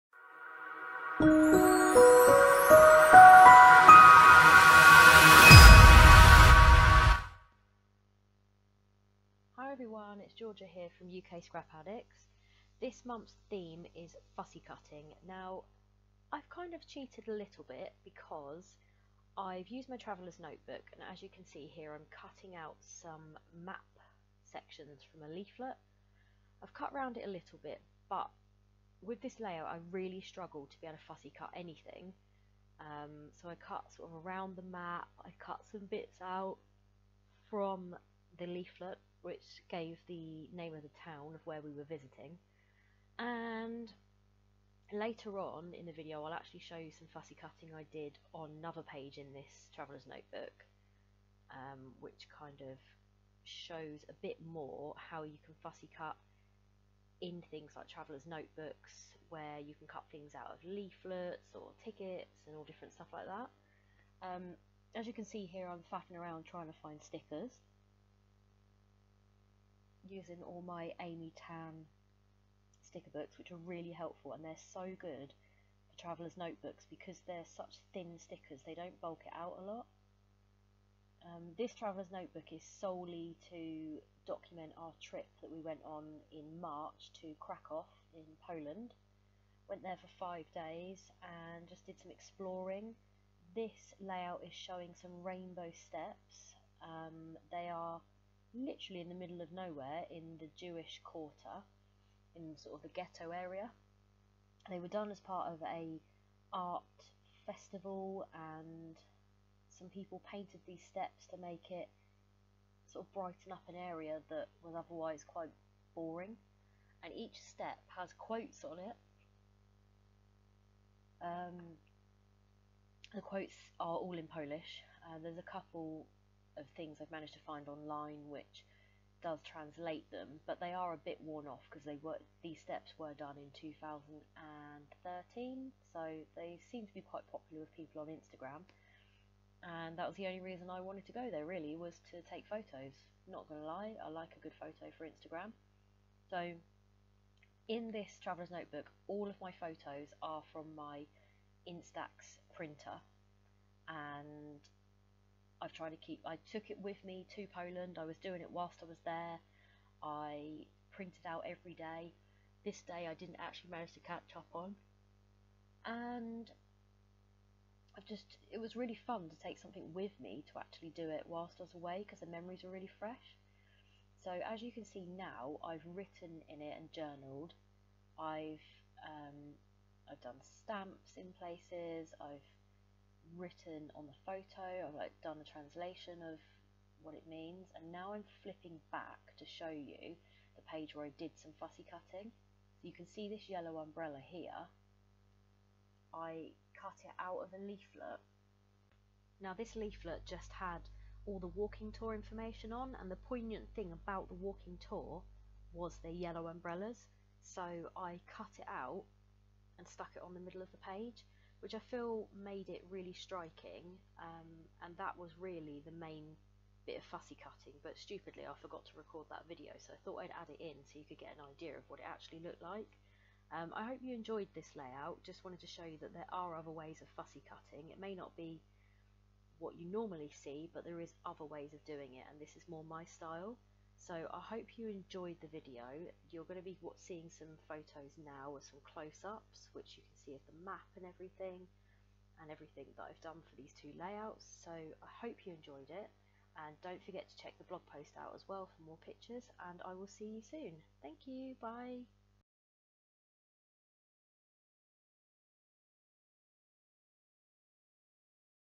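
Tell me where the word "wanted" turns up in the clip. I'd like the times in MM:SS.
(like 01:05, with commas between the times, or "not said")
02:20, 03:45.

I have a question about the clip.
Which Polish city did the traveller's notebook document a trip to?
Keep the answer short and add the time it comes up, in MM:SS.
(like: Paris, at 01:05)
Krakow, at 01:27.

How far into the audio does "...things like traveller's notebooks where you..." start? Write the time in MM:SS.
00:57.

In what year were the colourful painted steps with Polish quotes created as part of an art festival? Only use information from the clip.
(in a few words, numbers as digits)
2013.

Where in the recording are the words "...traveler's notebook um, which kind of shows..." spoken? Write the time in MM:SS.
00:49.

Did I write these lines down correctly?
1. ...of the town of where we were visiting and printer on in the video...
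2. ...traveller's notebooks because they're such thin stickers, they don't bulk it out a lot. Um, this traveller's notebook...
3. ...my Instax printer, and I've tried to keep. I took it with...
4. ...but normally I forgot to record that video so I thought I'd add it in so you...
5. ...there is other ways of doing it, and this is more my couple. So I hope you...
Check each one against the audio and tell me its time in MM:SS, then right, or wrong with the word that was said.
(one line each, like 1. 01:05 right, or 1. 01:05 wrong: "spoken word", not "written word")
1. 00:40 wrong: "later", not "printer"
2. 01:16 right
3. 02:30 right
4. 03:37 wrong: "stupidly", not "normally"
5. 03:50 wrong: "style", not "couple".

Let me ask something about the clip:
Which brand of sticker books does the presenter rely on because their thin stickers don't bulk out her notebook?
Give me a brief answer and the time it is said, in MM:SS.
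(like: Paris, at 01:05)
Amy Tan, at 01:10.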